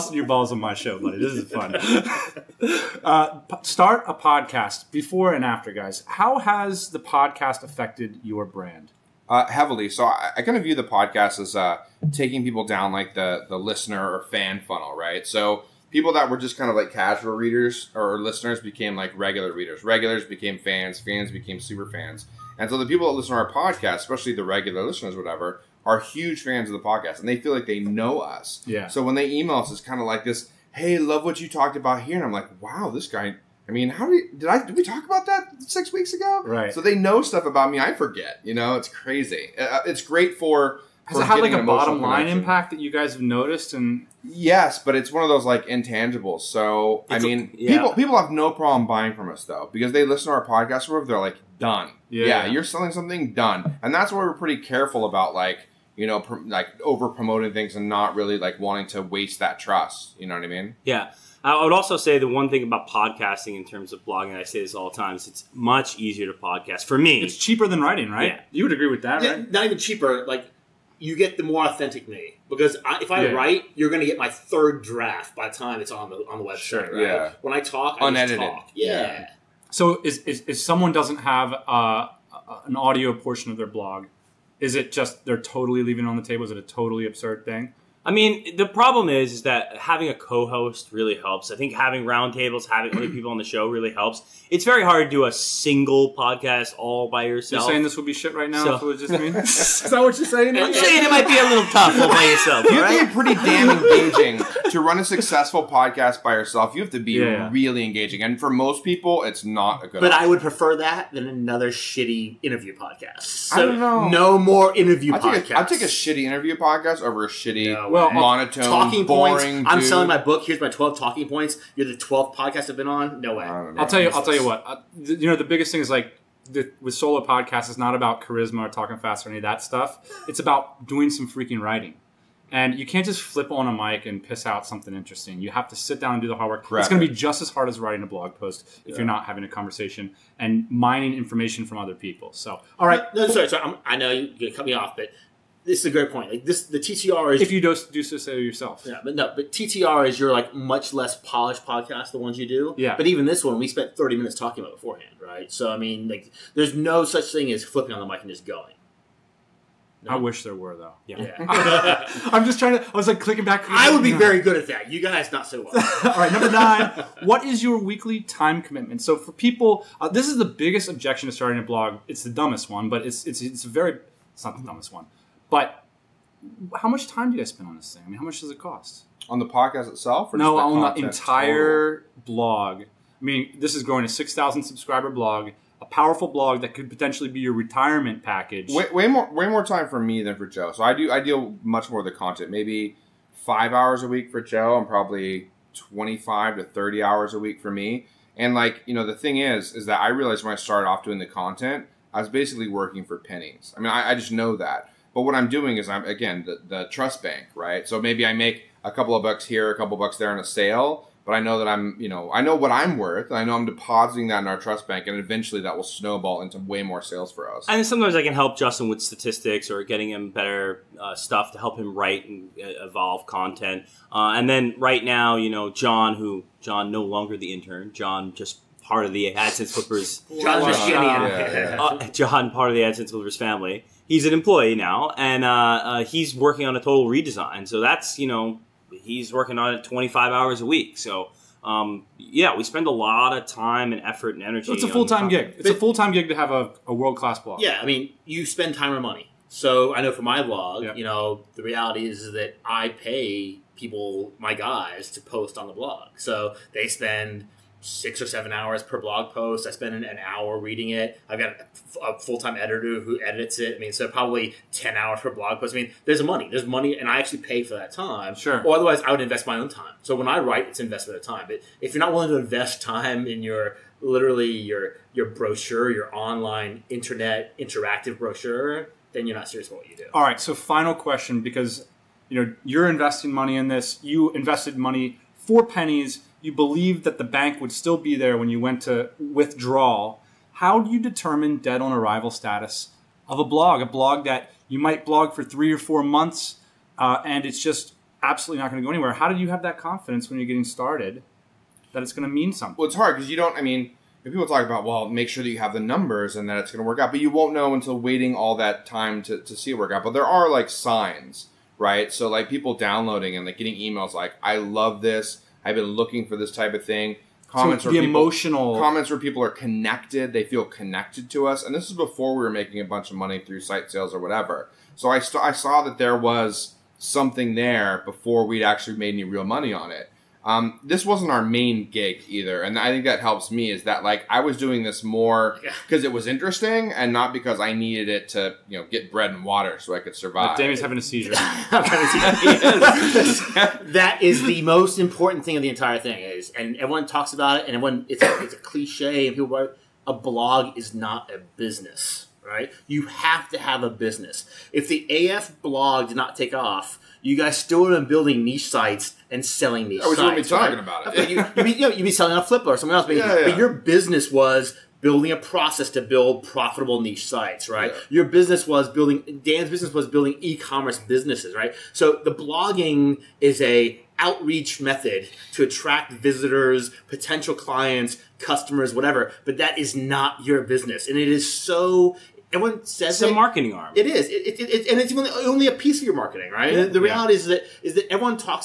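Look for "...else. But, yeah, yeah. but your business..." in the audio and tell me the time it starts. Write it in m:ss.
6:02.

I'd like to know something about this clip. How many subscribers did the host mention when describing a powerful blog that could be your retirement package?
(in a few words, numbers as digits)
6,000.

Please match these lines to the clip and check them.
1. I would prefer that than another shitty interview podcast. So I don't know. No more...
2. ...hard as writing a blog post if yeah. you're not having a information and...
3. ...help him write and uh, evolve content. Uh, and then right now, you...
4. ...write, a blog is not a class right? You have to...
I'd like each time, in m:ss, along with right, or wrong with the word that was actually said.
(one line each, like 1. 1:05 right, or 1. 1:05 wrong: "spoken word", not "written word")
1. 1:50 right
2. 2:17 wrong: "conversation", not "information"
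3. 3:41 right
4. 5:49 wrong: "business", not "class".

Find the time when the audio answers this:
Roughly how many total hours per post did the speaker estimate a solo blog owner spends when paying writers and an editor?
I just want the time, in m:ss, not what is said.
4:24.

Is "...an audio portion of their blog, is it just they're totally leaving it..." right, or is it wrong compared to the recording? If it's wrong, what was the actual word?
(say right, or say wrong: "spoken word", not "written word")
right.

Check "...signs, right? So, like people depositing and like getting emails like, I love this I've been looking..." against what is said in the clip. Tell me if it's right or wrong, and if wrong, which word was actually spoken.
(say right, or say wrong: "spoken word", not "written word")
wrong: "downloading", not "depositing".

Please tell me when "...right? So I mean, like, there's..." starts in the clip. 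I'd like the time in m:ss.
2:35.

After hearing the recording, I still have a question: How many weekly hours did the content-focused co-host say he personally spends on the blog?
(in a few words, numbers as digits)
25 to 30 hours.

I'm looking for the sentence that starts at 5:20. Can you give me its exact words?
They feel connected to us, and this is before we were making a bunch of money through site sales or whatever.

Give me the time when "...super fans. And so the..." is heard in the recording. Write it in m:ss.
0:21.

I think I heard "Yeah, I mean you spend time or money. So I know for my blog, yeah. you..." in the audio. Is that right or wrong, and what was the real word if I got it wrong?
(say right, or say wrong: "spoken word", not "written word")
right.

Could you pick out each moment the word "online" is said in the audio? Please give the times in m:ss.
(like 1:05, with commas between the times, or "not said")
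4:36.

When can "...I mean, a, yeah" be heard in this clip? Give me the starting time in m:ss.
0:47.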